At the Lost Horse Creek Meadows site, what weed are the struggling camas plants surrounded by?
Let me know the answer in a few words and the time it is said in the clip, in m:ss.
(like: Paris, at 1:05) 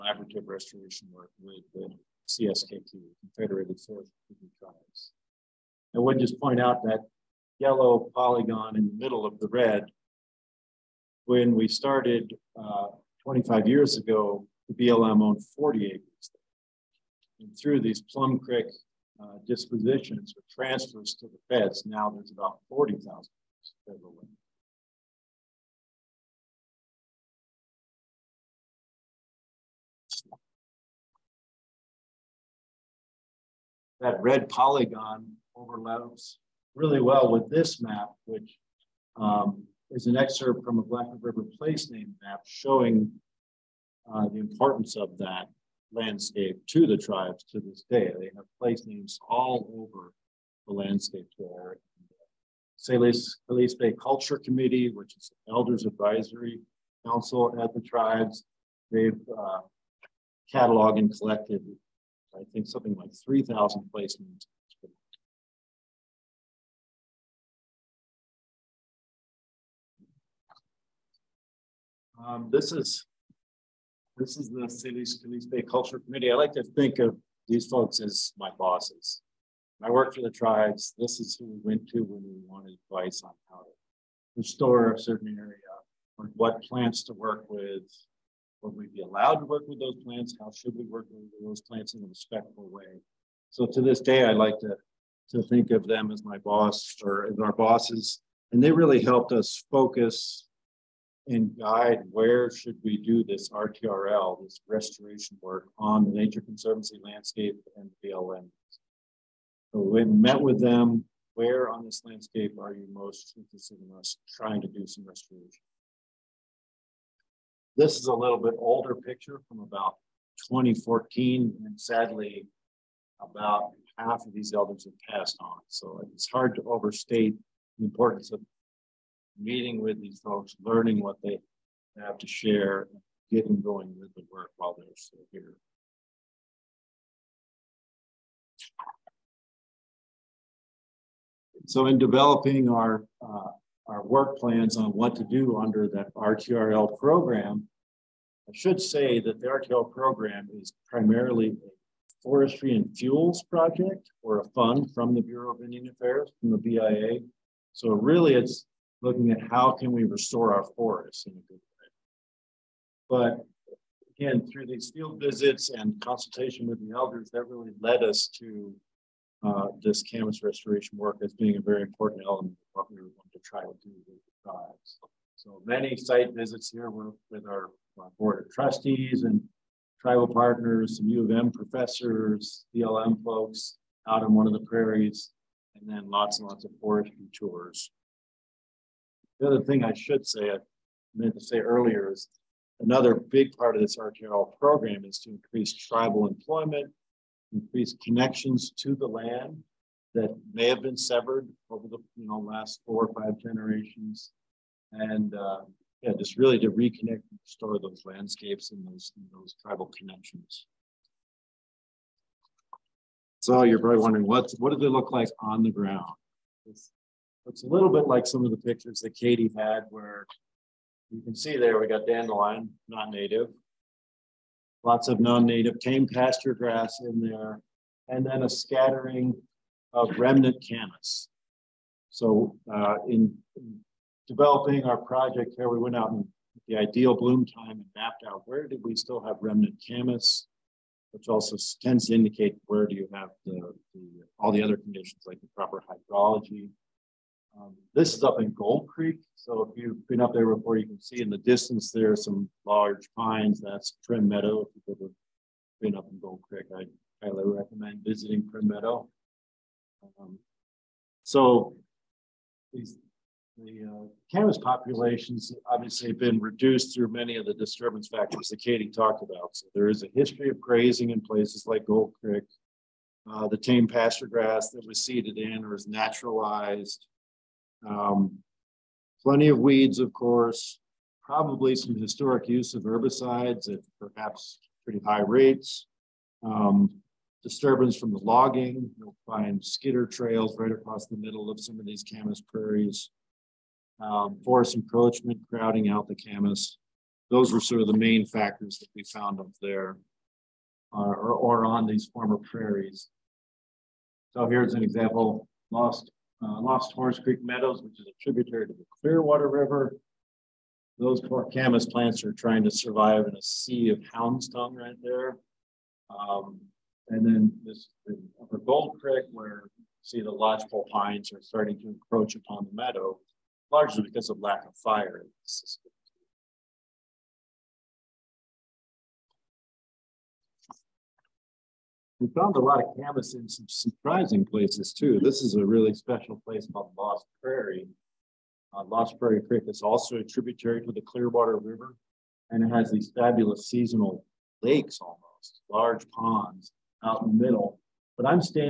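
hound's tongue, at 5:14.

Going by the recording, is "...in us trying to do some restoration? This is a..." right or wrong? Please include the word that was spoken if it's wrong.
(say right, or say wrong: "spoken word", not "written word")
right.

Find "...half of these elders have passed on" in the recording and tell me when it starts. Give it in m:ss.
2:03.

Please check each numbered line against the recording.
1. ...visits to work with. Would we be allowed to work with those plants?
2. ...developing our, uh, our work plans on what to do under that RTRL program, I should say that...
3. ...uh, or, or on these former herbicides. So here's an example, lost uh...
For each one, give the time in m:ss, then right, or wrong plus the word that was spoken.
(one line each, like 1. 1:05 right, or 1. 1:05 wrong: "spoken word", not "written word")
1. 1:26 wrong: "plants", not "visits"
2. 2:21 right
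3. 5:00 wrong: "prairies", not "herbicides".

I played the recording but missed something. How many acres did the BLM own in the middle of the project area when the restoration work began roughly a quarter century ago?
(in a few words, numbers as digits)
40.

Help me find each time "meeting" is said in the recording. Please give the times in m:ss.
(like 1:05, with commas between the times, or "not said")
2:09.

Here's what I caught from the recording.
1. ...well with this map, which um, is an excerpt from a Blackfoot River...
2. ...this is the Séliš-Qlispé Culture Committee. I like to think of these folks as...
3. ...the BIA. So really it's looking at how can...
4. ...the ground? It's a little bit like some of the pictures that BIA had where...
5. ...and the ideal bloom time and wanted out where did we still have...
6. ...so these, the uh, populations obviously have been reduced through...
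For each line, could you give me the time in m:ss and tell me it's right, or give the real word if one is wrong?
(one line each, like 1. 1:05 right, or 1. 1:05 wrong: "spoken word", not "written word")
1. 0:36 right
2. 1:14 right
3. 2:36 right
4. 3:35 wrong: "Katie", not "BIA"
5. 3:56 wrong: "mapped", not "wanted"
6. 4:21 right.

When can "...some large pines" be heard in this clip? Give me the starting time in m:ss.
4:12.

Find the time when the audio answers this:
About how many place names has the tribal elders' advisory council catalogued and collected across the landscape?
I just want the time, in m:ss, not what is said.
1:03.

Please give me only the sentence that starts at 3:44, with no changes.
Lots of non-native tame pasture grass in there, and then a scattering of remnant camas.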